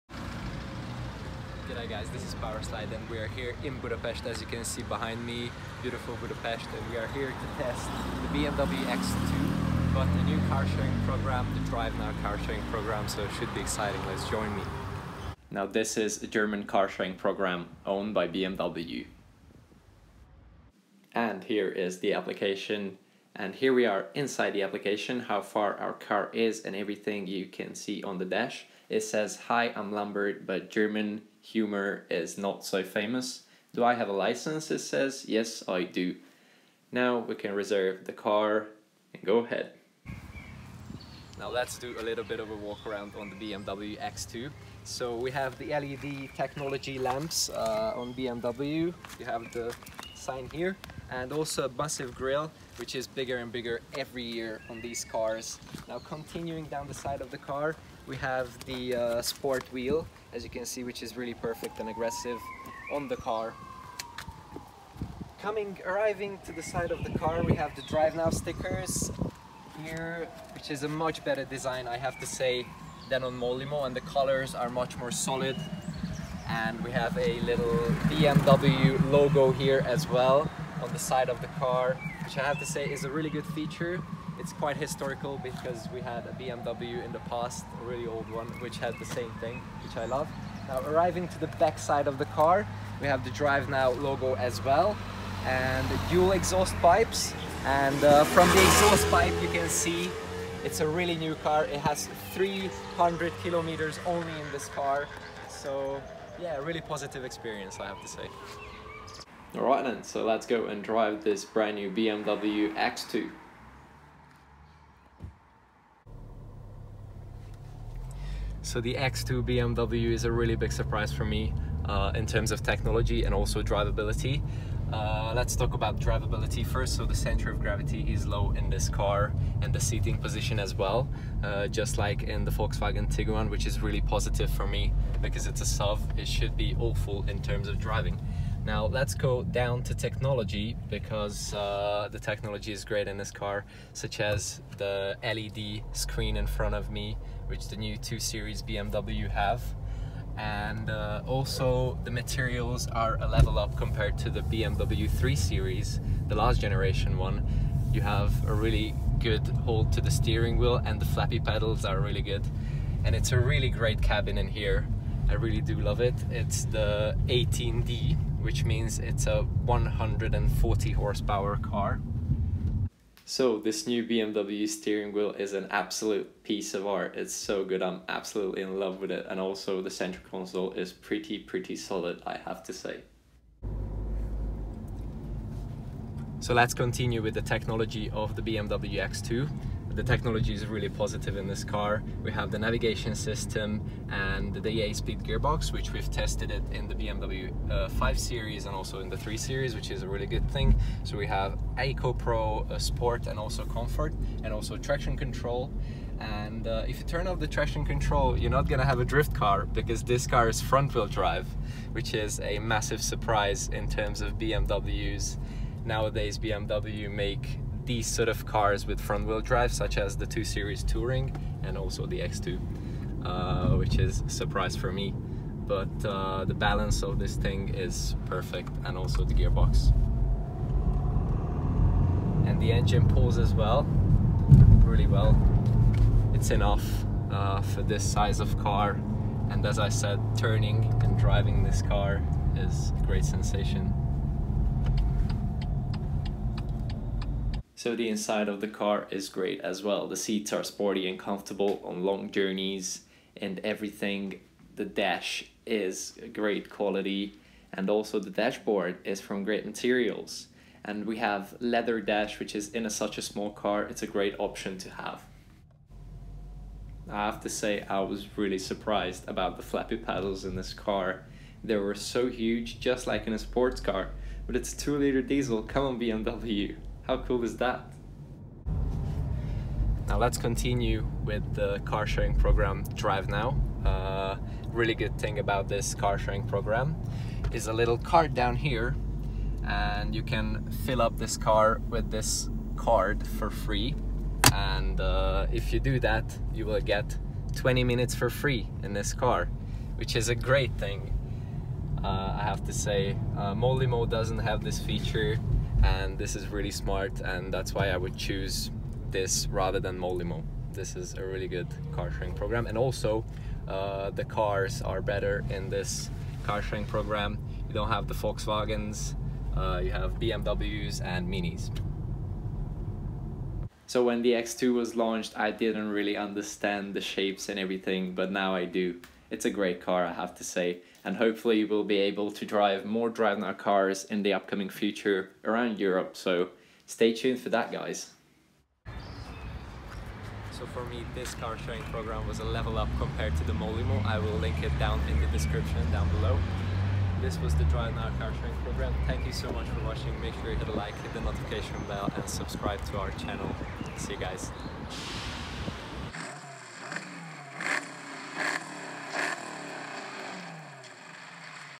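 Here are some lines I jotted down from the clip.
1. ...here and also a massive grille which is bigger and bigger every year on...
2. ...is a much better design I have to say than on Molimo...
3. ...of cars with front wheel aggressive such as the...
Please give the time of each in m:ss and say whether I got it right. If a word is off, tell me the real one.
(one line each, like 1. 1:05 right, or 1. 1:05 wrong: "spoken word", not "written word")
1. 0:50 right
2. 1:10 right
3. 3:38 wrong: "drive", not "aggressive".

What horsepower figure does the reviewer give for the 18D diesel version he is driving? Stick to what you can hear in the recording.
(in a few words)
140.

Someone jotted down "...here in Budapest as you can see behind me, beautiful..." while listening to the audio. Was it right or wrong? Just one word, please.
right.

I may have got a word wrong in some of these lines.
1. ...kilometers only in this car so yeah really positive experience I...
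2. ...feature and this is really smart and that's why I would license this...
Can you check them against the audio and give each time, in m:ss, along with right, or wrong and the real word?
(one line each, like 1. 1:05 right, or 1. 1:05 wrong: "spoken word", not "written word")
1. 1:43 right
2. 5:04 wrong: "choose", not "license".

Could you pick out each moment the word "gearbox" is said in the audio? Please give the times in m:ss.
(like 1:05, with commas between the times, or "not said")
3:15, 3:49.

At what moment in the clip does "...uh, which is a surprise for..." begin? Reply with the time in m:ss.
3:43.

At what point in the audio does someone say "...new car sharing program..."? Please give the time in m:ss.
0:10.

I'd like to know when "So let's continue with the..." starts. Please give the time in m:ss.
3:06.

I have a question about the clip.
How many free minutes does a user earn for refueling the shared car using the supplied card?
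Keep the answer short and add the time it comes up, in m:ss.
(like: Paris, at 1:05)
20 minutes, at 4:57.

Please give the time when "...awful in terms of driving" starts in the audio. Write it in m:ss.
2:16.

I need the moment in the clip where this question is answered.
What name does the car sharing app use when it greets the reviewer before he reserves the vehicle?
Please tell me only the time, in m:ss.
0:29.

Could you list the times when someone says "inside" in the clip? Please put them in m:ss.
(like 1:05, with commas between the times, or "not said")
0:24, 4:08.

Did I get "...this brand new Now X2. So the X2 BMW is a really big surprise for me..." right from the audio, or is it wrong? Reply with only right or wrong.
wrong.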